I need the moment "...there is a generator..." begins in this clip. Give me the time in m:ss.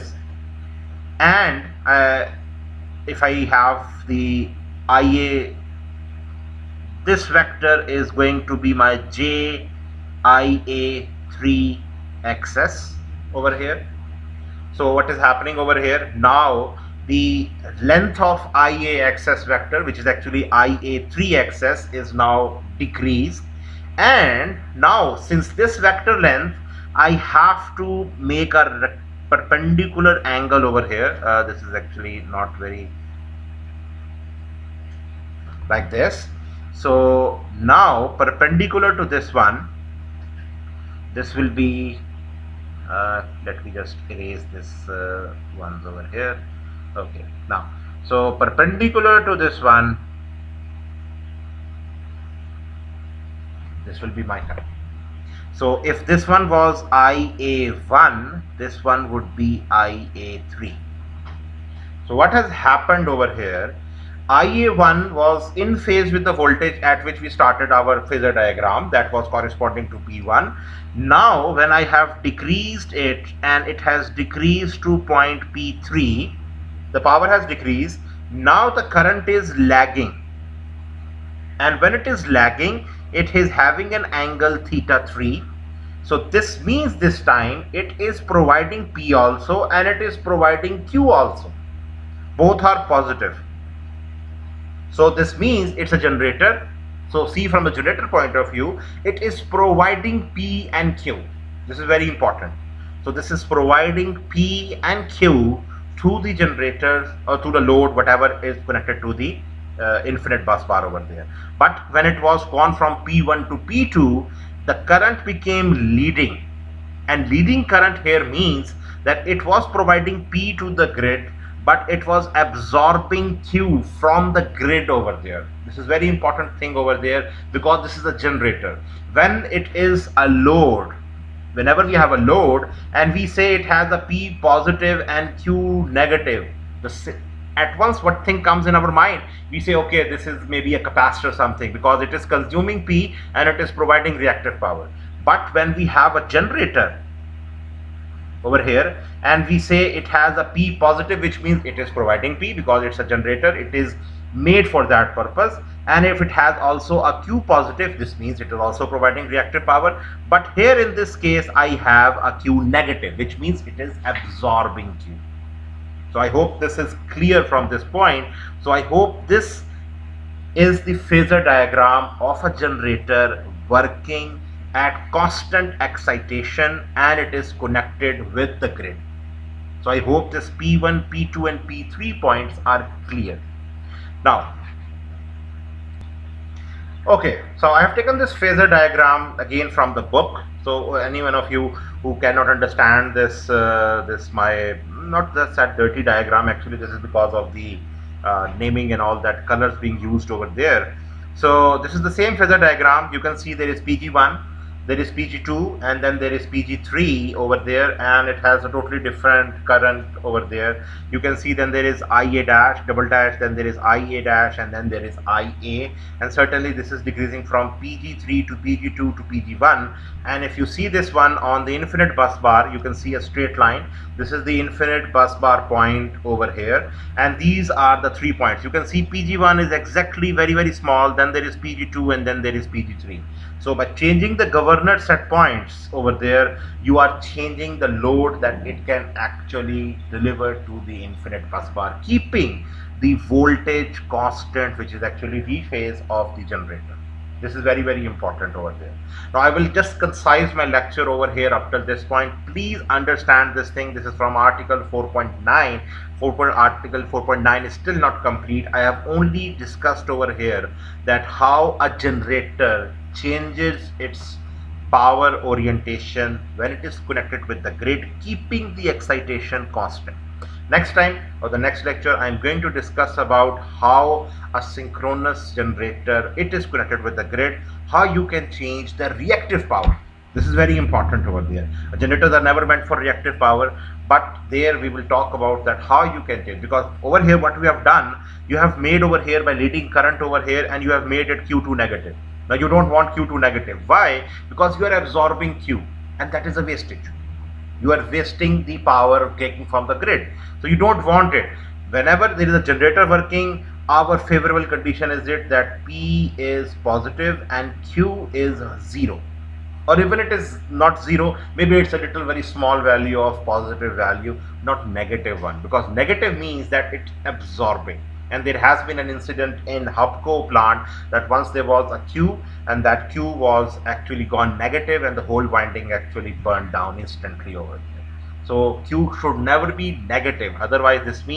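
5:02.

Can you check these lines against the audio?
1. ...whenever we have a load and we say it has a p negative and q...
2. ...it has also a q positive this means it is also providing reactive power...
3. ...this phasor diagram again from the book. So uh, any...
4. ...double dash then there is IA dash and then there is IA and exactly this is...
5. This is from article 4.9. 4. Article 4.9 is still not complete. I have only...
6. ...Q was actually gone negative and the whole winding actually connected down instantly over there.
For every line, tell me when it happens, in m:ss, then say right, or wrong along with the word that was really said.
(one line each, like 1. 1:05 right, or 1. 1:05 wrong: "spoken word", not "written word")
1. 2:11 wrong: "positive", not "negative"
2. 2:36 right
3. 3:08 right
4. 3:32 wrong: "certainly", not "exactly"
5. 4:13 right
6. 5:23 wrong: "burned", not "connected".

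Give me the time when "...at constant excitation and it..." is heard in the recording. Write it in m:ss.
2:54.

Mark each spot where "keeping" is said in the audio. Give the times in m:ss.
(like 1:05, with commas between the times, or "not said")
4:02, 4:28.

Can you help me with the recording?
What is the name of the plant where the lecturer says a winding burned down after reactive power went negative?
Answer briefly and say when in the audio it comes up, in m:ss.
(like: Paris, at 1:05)
Hubco, at 5:19.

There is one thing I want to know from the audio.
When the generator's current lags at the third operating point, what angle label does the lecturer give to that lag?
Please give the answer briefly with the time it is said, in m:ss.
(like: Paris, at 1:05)
theta 3, at 1:24.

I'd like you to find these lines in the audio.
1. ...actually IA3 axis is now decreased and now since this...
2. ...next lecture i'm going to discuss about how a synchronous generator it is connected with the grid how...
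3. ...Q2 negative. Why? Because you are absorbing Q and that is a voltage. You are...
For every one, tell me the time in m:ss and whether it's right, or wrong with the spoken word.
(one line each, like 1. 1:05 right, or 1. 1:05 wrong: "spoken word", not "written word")
1. 0:20 right
2. 4:31 right
3. 4:53 wrong: "wastage", not "voltage".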